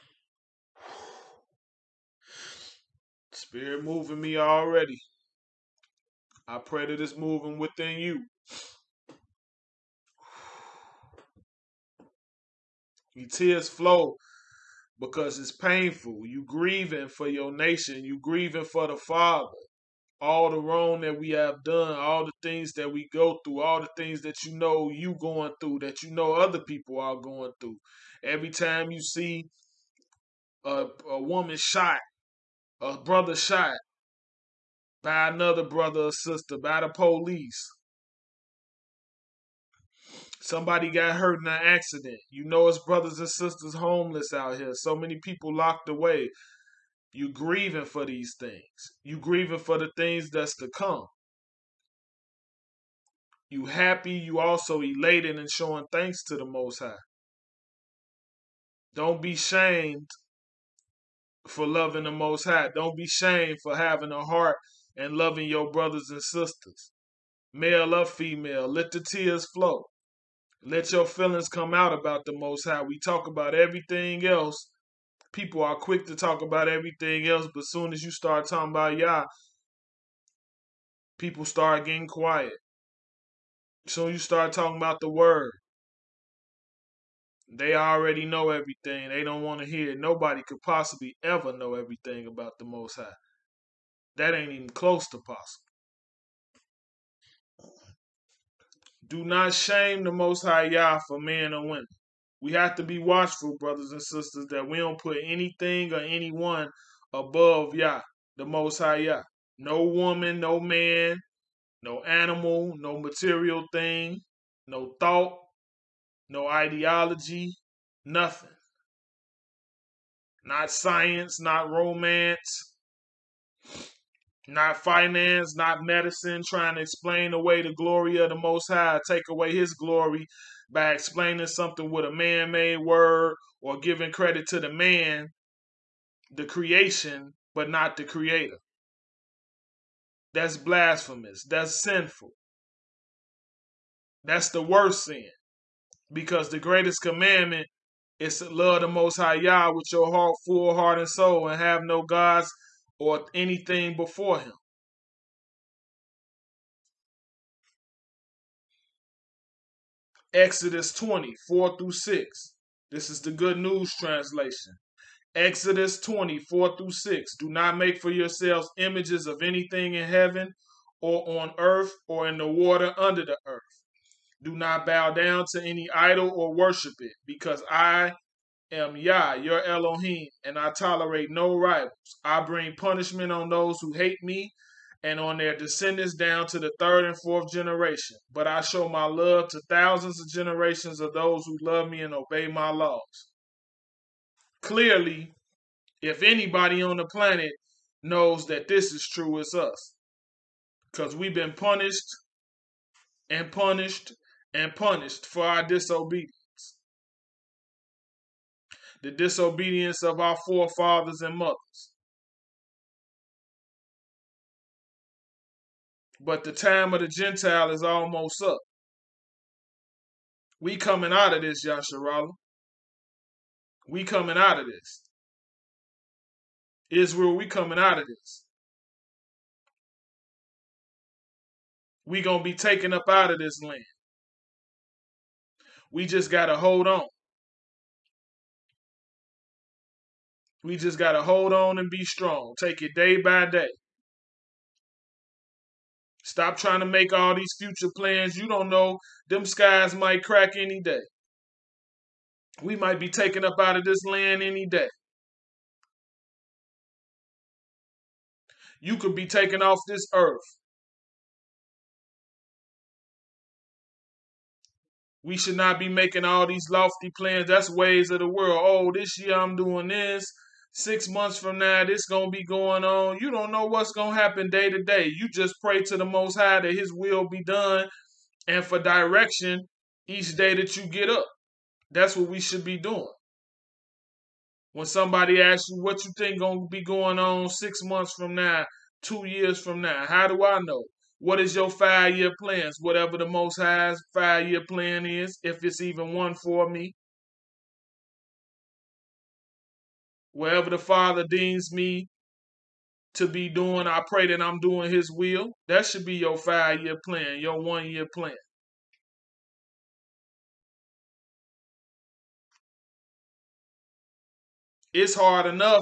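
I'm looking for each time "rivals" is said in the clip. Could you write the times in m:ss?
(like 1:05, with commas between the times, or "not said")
3:01.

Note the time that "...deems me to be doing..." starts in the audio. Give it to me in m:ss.
5:01.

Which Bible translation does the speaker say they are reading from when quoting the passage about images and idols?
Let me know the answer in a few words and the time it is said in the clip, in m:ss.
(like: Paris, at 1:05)
Good News Translation, at 2:43.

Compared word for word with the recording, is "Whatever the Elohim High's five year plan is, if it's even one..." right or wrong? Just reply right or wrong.
wrong.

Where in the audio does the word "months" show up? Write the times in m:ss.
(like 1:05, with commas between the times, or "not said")
4:31, 4:47.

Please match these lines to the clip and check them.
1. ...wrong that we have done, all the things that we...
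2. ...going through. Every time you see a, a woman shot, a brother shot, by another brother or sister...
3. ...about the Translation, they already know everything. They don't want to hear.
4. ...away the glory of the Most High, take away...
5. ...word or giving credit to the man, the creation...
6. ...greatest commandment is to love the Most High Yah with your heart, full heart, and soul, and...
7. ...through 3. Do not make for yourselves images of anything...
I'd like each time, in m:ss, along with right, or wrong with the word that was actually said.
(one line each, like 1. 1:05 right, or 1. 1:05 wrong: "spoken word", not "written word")
1. 0:20 right
2. 0:27 right
3. 1:24 wrong: "Word", not "Translation"
4. 2:07 right
5. 2:12 right
6. 2:26 right
7. 2:46 wrong: "6", not "3".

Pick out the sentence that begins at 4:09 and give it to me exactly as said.
Them skies might crack any day.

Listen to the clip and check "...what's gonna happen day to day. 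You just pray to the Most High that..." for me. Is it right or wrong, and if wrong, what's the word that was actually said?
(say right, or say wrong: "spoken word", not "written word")
right.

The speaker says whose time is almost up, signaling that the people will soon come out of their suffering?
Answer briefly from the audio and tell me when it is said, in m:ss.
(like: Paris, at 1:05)
the Gentile, at 3:37.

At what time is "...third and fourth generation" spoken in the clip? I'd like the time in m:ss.
3:06.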